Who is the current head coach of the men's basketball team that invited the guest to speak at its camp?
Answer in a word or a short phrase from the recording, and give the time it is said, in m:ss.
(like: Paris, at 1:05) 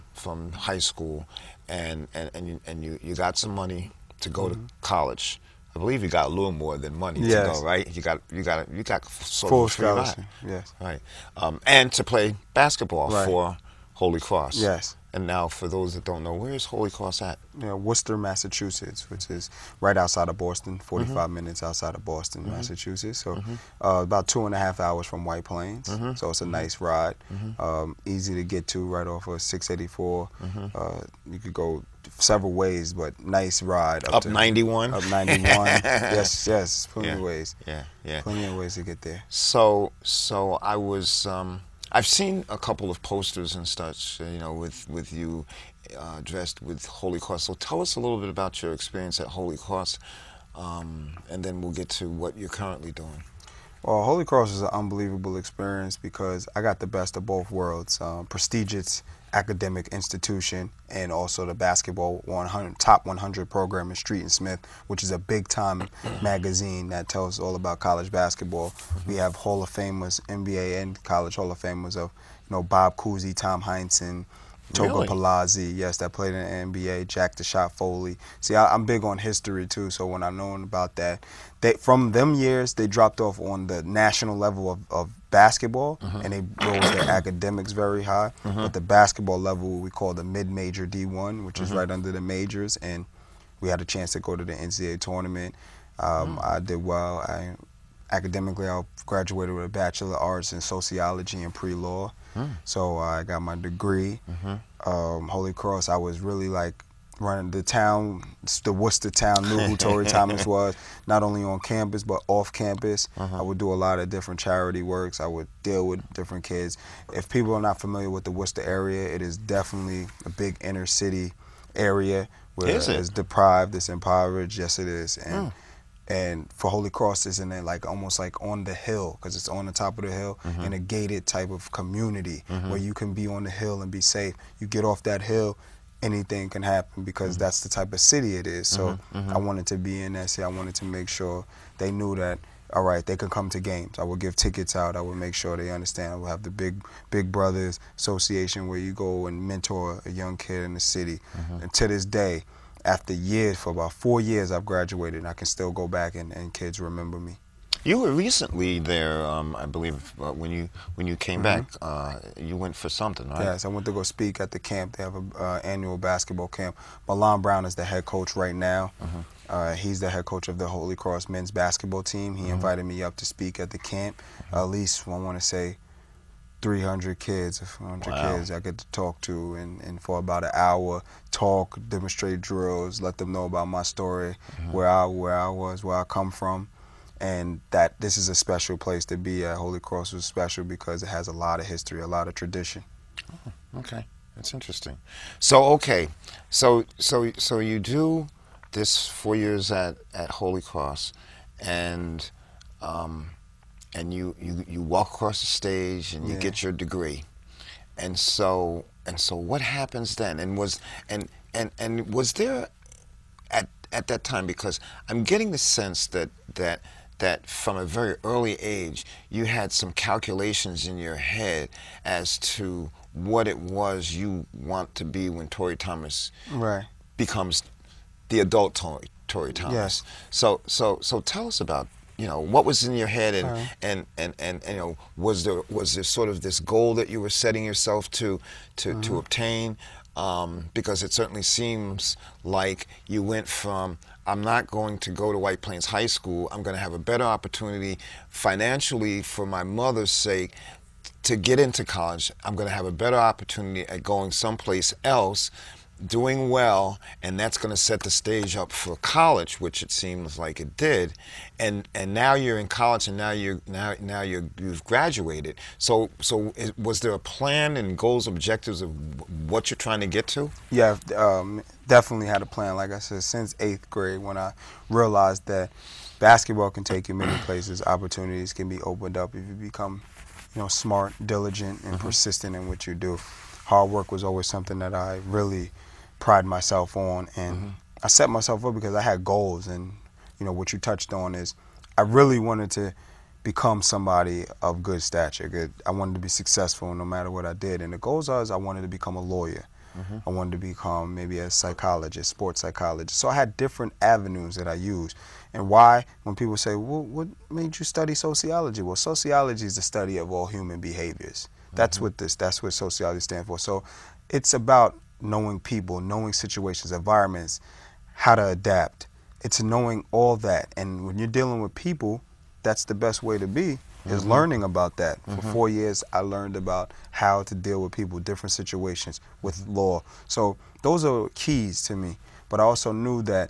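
Milan Brown, at 2:47.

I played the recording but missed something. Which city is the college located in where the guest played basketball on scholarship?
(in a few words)
Worcester, Massachusetts.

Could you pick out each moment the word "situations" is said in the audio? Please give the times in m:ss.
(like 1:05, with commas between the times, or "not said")
5:16, 5:28.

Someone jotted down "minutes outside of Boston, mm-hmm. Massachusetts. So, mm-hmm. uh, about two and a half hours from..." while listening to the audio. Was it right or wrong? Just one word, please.
right.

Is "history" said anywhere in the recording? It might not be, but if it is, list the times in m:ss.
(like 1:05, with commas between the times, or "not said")
1:19, 3:11.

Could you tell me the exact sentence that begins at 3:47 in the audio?
becomes the adult Torey, Torey Thomas.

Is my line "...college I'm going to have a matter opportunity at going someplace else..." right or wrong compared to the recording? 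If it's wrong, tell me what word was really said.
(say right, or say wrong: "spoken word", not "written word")
wrong: "better", not "matter".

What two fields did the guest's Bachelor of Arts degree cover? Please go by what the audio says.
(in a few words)
Sociology and Pre-Law.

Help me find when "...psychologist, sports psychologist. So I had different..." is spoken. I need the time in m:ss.
5:01.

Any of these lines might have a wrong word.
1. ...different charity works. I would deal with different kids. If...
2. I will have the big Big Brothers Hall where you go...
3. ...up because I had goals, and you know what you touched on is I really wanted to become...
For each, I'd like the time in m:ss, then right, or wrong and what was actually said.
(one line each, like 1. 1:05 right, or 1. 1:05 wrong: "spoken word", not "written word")
1. 1:54 right
2. 2:26 wrong: "Association", not "Hall"
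3. 4:48 right.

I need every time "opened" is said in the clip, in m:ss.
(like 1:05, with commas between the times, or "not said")
4:38.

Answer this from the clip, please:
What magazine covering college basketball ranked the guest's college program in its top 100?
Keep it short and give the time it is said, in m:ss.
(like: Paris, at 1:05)
Street and Smith, at 1:03.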